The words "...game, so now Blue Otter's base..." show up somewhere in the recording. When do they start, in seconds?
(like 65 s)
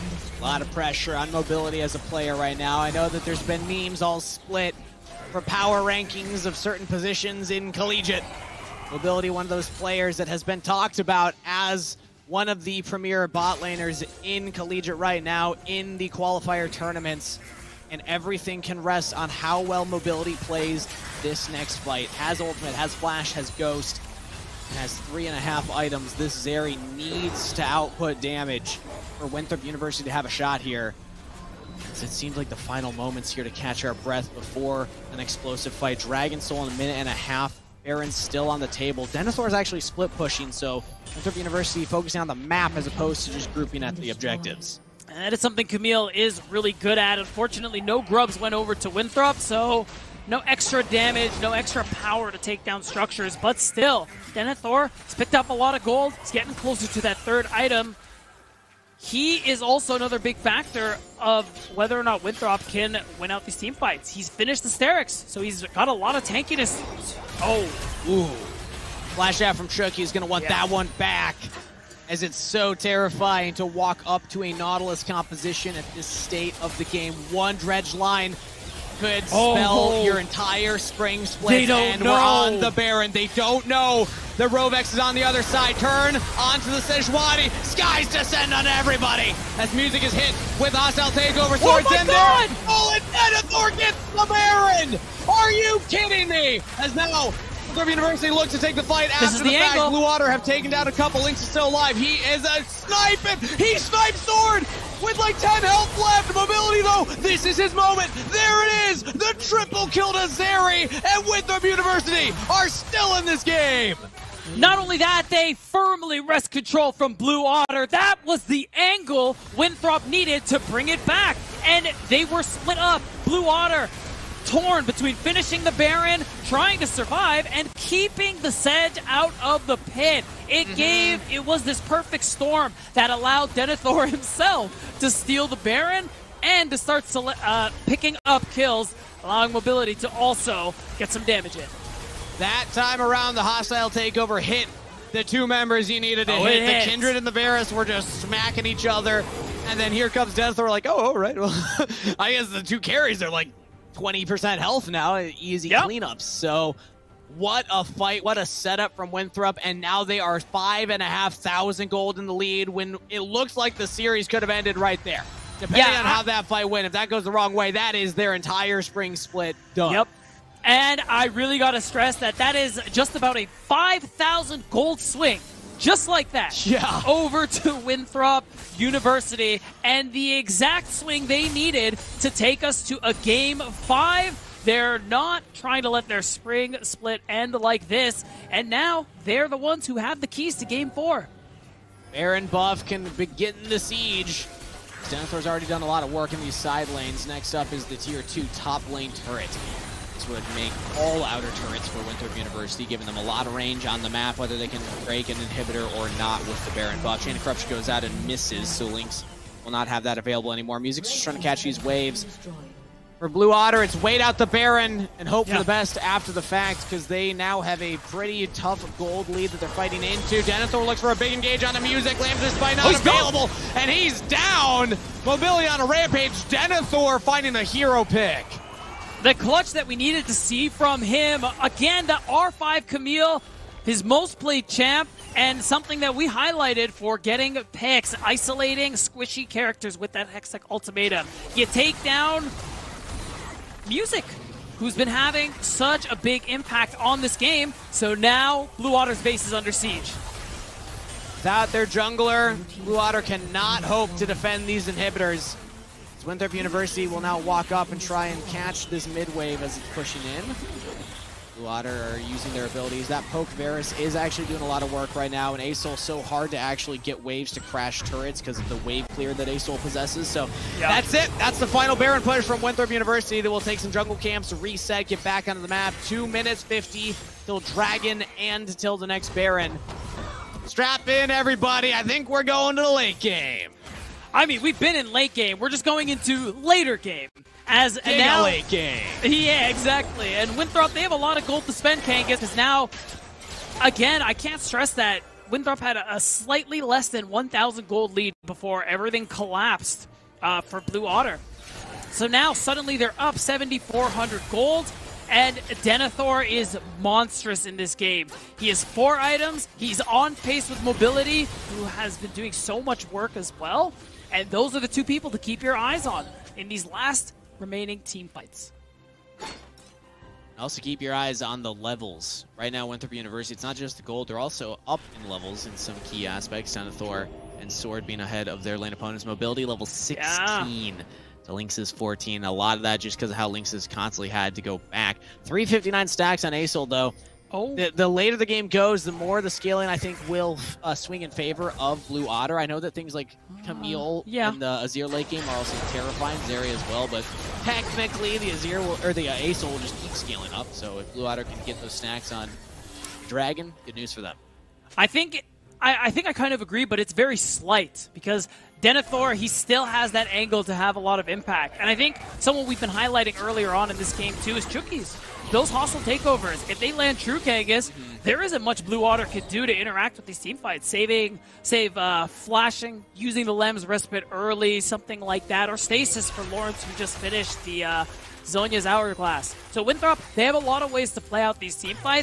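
247 s.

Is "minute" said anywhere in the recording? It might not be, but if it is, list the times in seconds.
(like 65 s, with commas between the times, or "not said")
36 s, 276 s.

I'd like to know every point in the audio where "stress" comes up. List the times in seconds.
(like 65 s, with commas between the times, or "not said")
171 s, 294 s.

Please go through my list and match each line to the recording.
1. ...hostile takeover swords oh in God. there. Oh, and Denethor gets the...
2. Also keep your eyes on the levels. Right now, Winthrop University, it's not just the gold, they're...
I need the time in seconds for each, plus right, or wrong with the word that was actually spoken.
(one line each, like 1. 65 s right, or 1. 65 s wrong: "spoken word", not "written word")
1. 90 s right
2. 320 s right.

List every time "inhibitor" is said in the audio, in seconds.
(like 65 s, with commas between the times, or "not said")
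205 s, 254 s.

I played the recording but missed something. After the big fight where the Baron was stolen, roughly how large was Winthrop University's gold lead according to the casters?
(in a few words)
5,500.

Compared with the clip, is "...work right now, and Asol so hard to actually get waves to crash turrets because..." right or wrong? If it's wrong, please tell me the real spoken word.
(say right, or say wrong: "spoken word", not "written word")
right.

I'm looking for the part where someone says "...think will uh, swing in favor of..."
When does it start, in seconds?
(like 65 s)
339 s.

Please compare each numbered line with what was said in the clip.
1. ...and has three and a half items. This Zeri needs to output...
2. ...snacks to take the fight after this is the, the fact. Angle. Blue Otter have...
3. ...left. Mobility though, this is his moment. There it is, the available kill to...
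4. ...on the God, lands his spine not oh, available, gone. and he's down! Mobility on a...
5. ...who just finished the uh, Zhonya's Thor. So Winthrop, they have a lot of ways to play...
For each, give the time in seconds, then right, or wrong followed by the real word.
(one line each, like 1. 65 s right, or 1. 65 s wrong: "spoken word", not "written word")
1. 24 s right
2. 98 s wrong: "looks", not "snacks"
3. 105 s wrong: "triple", not "available"
4. 221 s wrong: "Music", not "God"
5. 376 s wrong: "Hourglass", not "Thor".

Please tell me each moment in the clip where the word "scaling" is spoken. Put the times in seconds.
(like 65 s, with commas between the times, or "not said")
339 s, 350 s.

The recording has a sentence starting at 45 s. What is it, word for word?
And that is something Camille is really good at.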